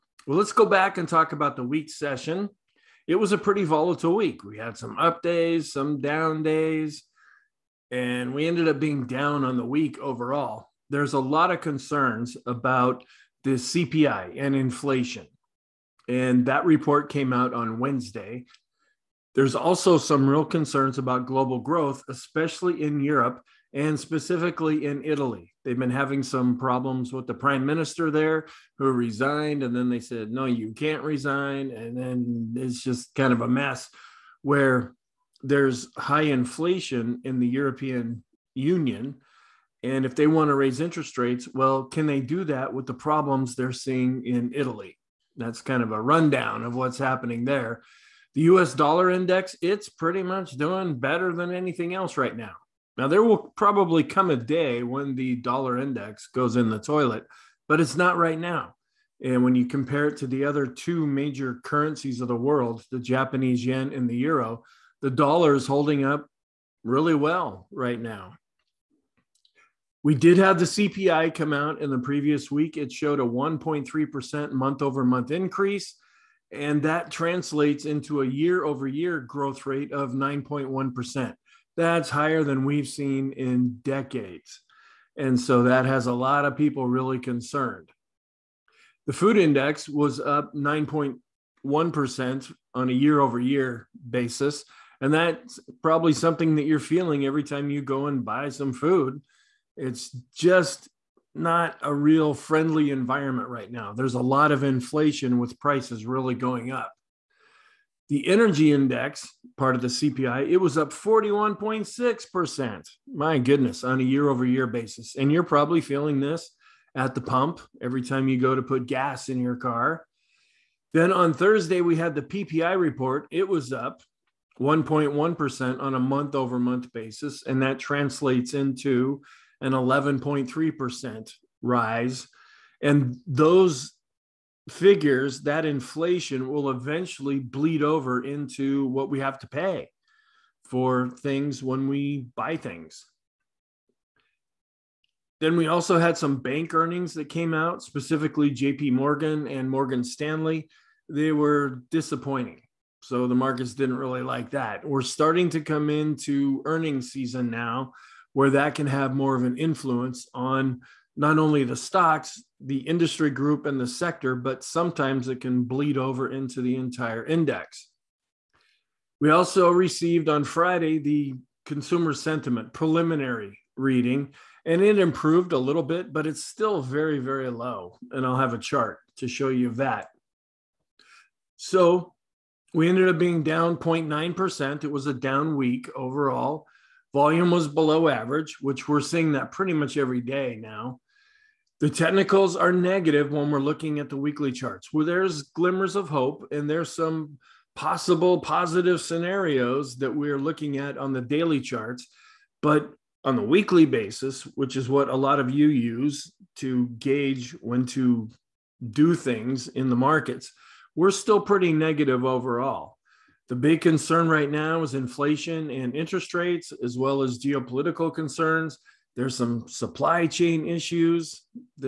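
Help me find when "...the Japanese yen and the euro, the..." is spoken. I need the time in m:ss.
1:02.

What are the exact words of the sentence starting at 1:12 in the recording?
It showed a 1.3% month over month increase.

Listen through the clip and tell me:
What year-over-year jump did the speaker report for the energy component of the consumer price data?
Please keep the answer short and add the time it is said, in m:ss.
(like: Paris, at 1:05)
41.6%, at 1:50.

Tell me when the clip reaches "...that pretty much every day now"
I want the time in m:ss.
3:09.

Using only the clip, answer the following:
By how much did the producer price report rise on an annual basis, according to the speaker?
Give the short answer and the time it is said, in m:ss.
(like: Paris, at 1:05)
11.3%, at 2:09.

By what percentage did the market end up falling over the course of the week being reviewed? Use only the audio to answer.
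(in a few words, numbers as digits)
0.9%.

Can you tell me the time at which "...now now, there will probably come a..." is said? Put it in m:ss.
0:52.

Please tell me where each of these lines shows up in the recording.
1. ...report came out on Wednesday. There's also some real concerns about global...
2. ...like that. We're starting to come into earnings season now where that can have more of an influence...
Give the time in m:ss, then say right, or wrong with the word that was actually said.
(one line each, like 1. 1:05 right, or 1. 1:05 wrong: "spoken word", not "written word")
1. 0:16 right
2. 2:34 right.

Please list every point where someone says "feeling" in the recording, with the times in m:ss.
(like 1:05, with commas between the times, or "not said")
1:36, 1:55.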